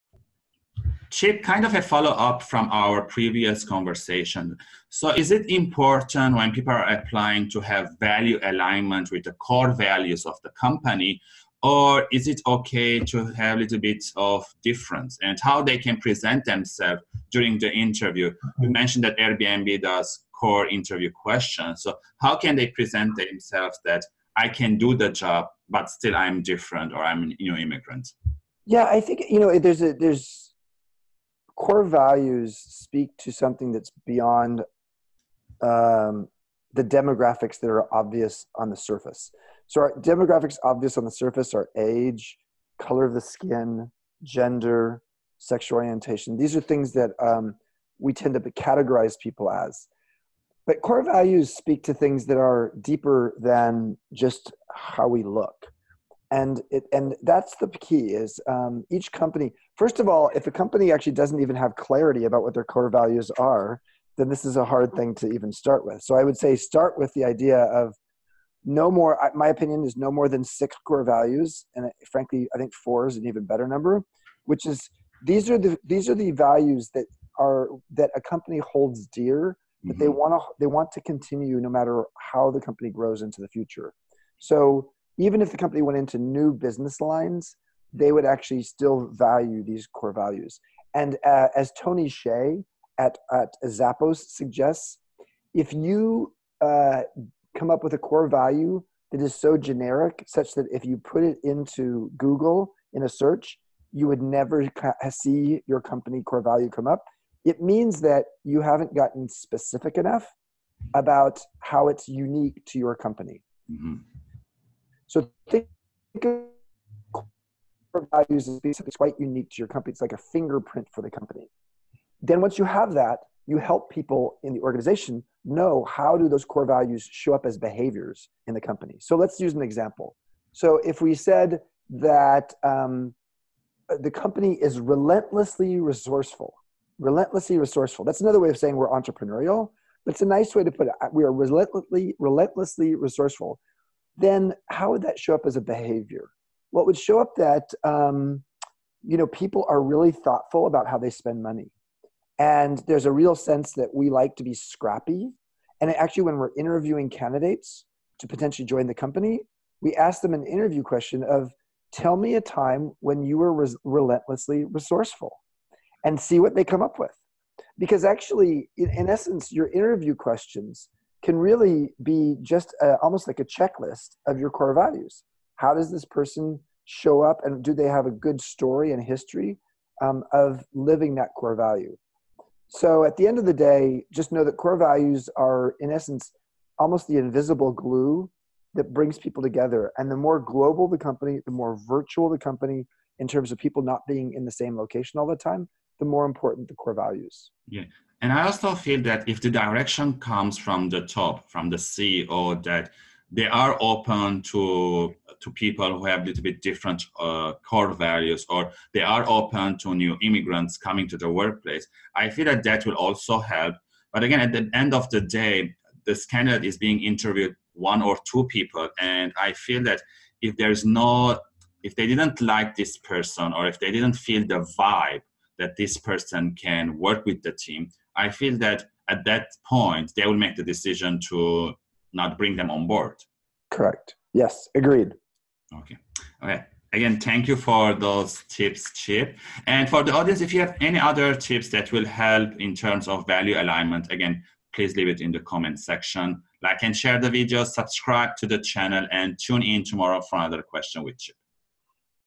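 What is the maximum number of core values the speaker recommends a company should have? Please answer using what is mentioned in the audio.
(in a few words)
6.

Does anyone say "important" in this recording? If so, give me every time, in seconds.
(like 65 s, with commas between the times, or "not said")
5 s, 196 s.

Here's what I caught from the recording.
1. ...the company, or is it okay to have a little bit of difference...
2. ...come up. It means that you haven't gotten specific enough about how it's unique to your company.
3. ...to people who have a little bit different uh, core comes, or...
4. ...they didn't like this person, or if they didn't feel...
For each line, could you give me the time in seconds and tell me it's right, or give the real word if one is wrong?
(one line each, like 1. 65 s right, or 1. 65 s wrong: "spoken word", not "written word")
1. 10 s right
2. 106 s right
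3. 205 s wrong: "values", not "comes"
4. 221 s right.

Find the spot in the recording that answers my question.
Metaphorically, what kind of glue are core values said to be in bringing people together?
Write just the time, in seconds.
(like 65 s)
187 s.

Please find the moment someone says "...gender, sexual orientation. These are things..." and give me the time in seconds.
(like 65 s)
44 s.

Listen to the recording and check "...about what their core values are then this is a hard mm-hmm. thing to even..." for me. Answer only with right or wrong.
right.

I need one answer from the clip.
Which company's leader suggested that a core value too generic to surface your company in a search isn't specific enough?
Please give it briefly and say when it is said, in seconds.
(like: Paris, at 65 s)
Zappos, at 93 s.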